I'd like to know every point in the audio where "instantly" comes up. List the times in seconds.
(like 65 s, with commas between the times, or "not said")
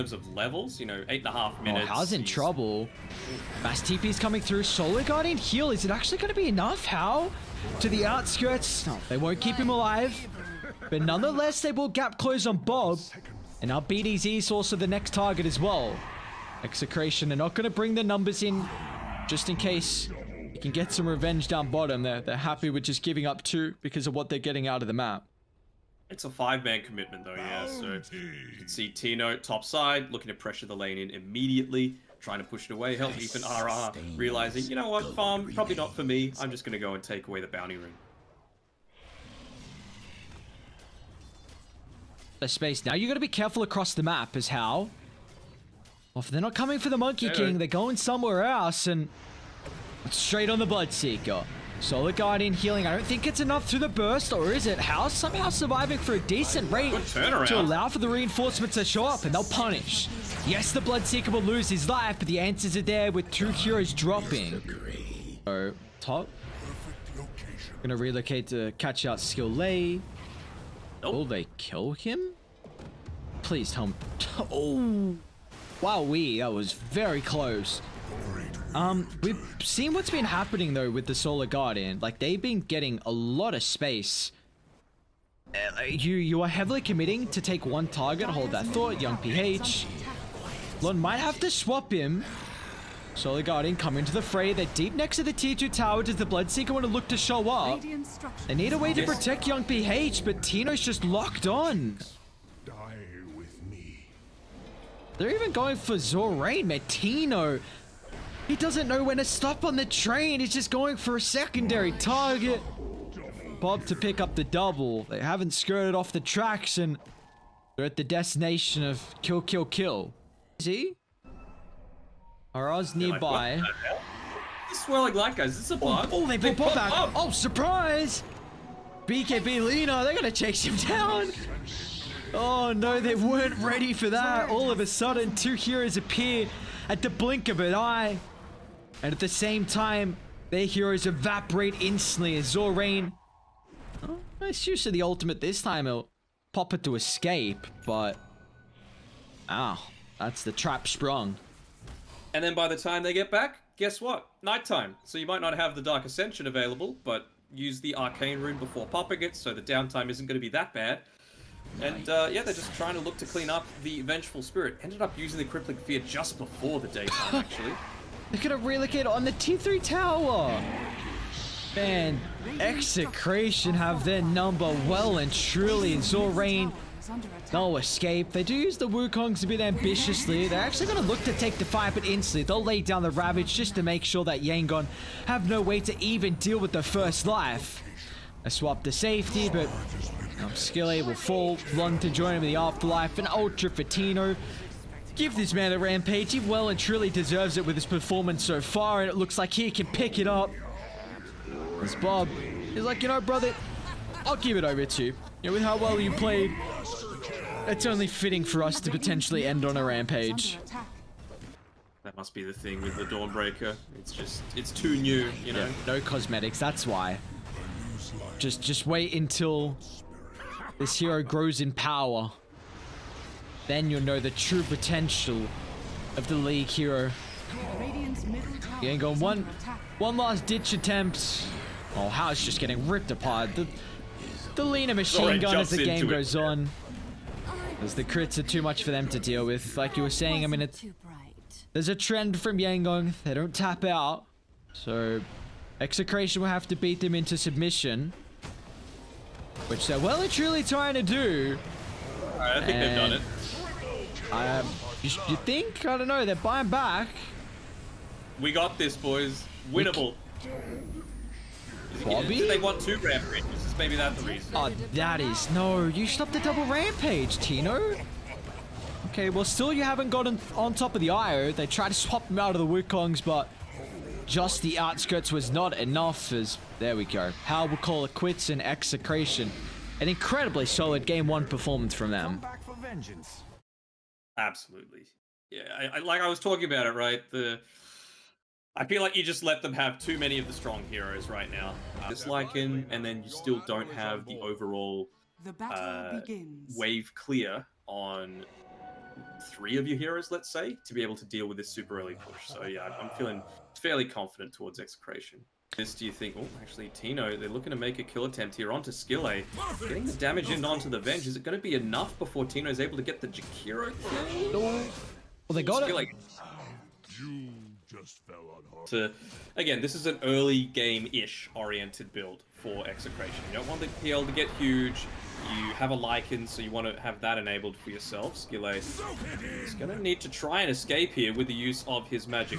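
141 s, 182 s.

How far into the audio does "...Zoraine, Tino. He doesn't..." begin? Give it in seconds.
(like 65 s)
105 s.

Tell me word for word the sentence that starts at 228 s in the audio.
You ain't going one, one last ditch attempt.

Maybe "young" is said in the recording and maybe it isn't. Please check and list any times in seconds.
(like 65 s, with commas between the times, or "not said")
89 s, 99 s.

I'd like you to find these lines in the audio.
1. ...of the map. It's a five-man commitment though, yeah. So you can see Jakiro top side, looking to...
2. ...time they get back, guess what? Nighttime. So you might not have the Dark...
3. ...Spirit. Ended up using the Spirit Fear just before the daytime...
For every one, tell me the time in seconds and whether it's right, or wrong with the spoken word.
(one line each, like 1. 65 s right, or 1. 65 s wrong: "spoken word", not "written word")
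1. 24 s wrong: "Tino", not "Jakiro"
2. 152 s right
3. 164 s wrong: "Crippling", not "Spirit".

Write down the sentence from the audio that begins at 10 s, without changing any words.
But nonetheless, they will gap close on Bob.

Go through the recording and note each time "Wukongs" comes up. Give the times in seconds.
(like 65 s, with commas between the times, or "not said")
178 s, 272 s.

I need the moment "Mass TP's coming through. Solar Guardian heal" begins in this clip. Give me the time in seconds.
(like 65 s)
3 s.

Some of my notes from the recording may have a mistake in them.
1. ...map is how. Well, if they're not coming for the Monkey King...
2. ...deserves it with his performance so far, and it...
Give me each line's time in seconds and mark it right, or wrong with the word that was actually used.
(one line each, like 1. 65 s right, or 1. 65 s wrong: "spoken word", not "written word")
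1. 44 s right
2. 197 s right.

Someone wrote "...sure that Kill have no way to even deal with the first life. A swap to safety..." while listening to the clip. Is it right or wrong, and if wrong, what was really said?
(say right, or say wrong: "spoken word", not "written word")
wrong: "Yangon", not "Kill".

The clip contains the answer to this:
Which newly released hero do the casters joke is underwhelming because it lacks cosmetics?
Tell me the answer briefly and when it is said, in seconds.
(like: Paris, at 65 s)
Dawnbreaker, at 213 s.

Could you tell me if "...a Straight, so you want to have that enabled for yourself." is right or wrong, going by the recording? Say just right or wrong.
wrong.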